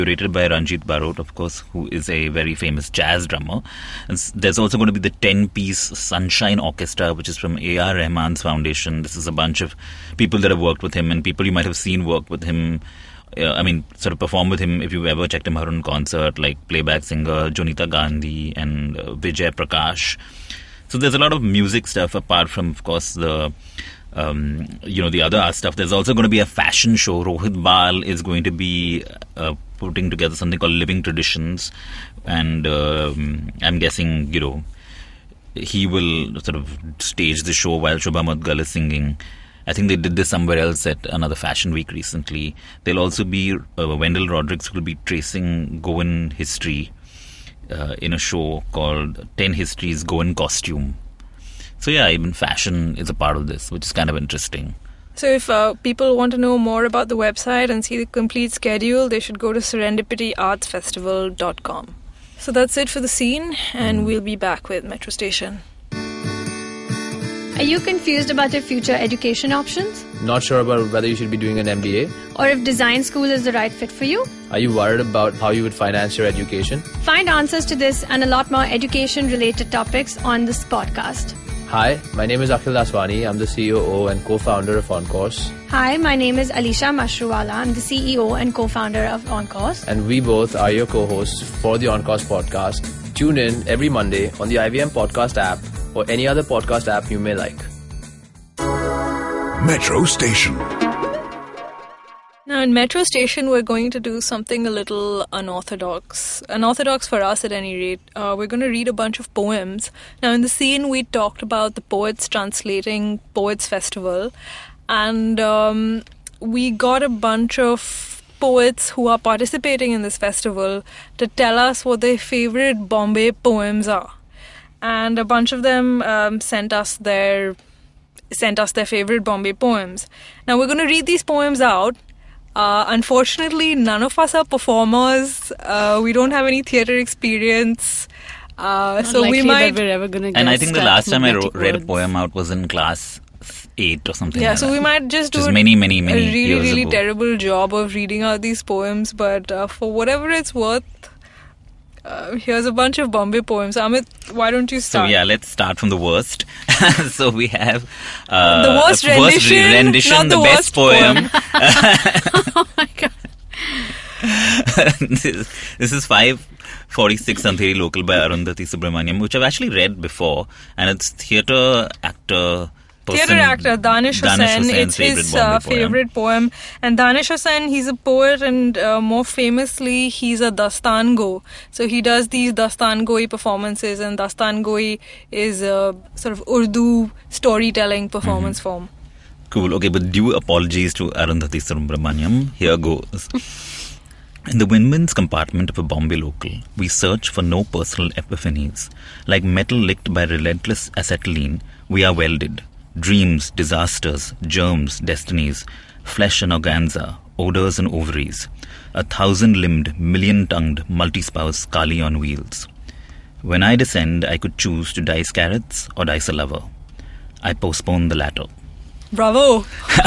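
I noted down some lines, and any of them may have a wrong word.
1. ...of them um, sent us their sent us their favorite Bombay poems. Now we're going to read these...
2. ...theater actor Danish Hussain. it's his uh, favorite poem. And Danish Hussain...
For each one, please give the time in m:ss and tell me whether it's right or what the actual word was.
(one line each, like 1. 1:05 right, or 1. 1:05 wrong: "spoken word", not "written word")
1. 2:05 right
2. 2:53 right.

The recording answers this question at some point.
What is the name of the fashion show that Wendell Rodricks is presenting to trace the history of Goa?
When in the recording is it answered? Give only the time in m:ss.
0:49.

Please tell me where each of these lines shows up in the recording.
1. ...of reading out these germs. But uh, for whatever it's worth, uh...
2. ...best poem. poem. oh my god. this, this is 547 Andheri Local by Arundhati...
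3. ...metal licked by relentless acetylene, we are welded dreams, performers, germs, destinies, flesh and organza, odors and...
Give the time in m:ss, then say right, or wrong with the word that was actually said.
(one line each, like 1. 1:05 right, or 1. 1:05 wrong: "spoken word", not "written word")
1. 2:27 wrong: "poems", not "germs"
2. 2:40 wrong: "546", not "547"
3. 3:19 wrong: "disasters", not "performers".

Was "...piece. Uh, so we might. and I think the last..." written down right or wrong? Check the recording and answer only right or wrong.
wrong.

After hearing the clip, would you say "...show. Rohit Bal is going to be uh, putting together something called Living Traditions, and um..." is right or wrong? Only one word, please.
right.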